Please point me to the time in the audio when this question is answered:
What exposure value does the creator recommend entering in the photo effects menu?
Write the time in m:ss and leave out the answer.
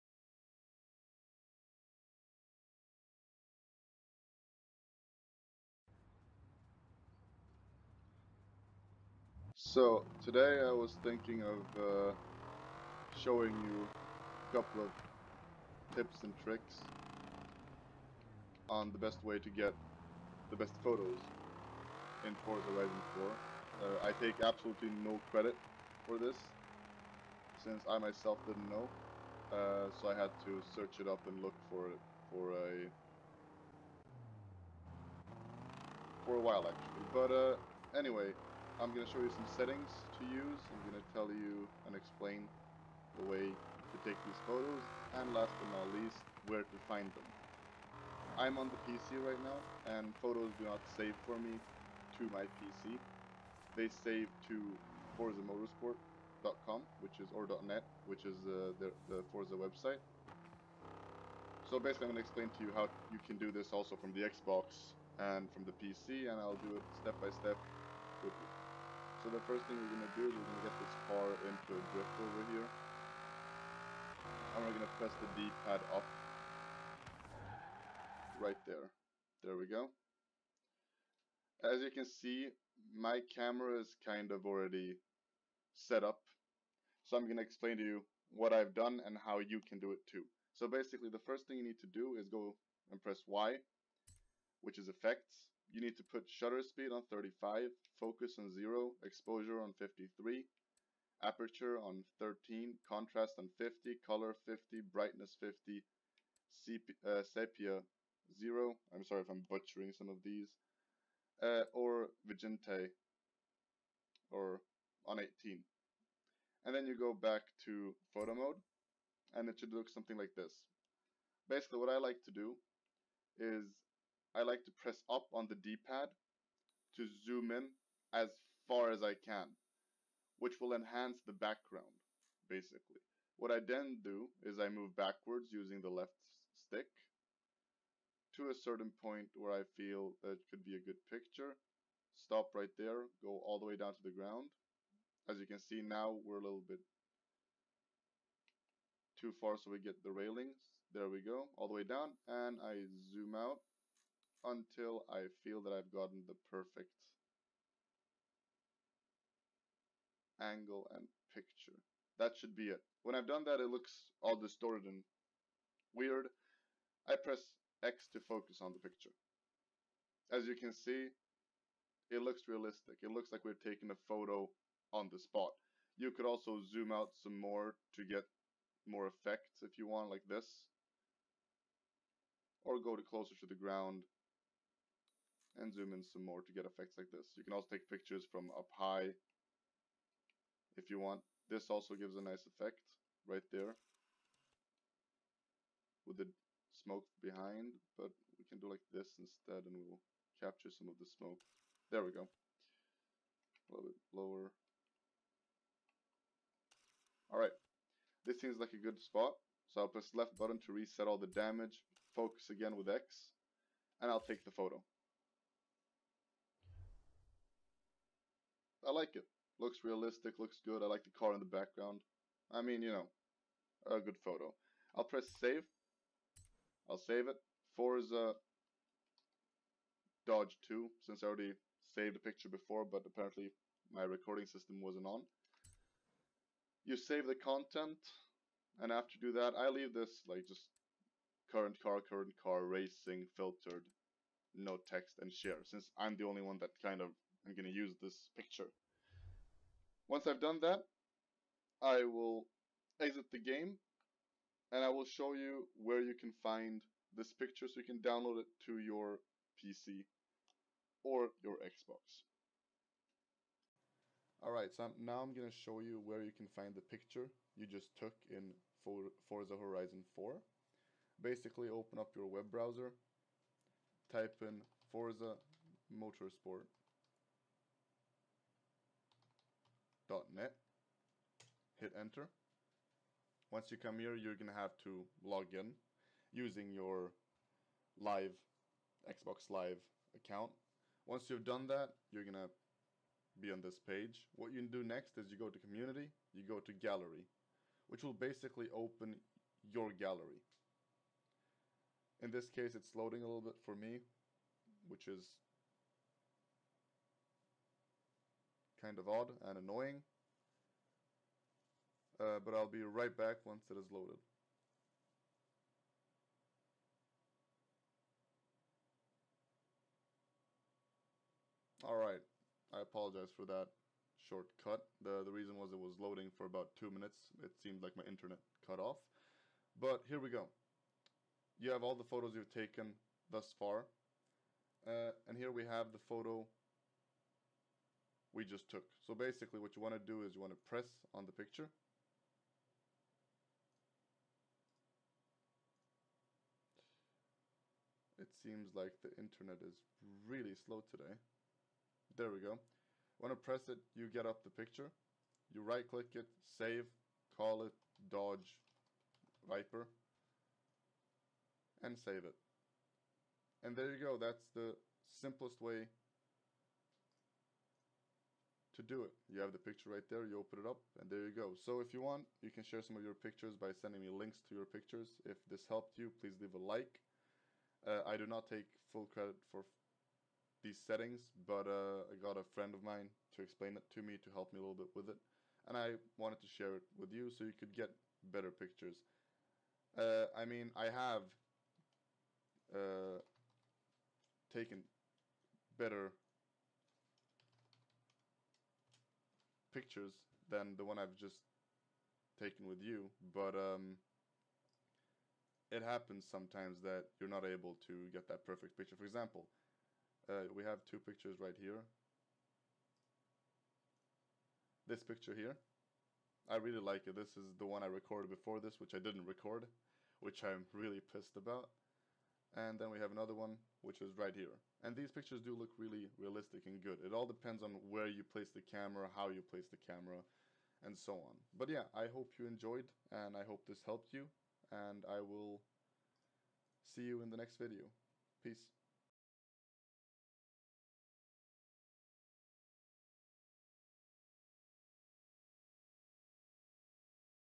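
1:39.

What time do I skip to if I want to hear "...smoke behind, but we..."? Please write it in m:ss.
3:16.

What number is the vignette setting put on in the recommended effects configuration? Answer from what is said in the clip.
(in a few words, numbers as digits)
18.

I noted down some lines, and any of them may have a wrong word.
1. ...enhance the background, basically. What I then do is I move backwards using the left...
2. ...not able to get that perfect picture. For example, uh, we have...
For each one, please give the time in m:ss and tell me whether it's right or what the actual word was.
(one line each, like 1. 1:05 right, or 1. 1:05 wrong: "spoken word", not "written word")
1. 2:10 right
2. 6:47 right.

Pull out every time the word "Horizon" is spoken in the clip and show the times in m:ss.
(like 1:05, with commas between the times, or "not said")
0:22, 4:29.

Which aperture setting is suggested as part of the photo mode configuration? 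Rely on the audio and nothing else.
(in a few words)
13.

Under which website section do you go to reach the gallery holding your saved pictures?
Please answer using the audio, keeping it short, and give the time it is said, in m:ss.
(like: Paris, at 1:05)
Community, at 4:55.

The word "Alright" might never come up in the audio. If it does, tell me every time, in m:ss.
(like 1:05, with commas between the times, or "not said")
3:27, 4:24, 5:21.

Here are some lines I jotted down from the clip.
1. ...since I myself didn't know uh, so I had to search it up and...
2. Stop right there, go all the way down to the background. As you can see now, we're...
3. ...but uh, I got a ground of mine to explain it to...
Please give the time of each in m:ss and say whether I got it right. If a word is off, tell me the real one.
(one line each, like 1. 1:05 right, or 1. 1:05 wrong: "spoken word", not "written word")
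1. 0:27 right
2. 2:22 wrong: "ground", not "background"
3. 6:21 wrong: "friend", not "ground".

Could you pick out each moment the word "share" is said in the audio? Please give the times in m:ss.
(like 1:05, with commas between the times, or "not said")
4:05, 6:12, 6:26.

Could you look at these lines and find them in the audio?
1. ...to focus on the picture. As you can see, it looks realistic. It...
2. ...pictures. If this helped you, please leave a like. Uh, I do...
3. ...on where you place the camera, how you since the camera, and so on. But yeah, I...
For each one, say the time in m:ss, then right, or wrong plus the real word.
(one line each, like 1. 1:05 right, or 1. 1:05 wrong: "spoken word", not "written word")
1. 2:48 right
2. 6:14 right
3. 7:07 wrong: "place", not "since".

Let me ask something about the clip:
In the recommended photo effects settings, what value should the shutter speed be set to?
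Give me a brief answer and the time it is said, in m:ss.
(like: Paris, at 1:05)
35, at 1:37.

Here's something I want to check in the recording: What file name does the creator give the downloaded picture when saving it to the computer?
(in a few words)
Dodge Viper.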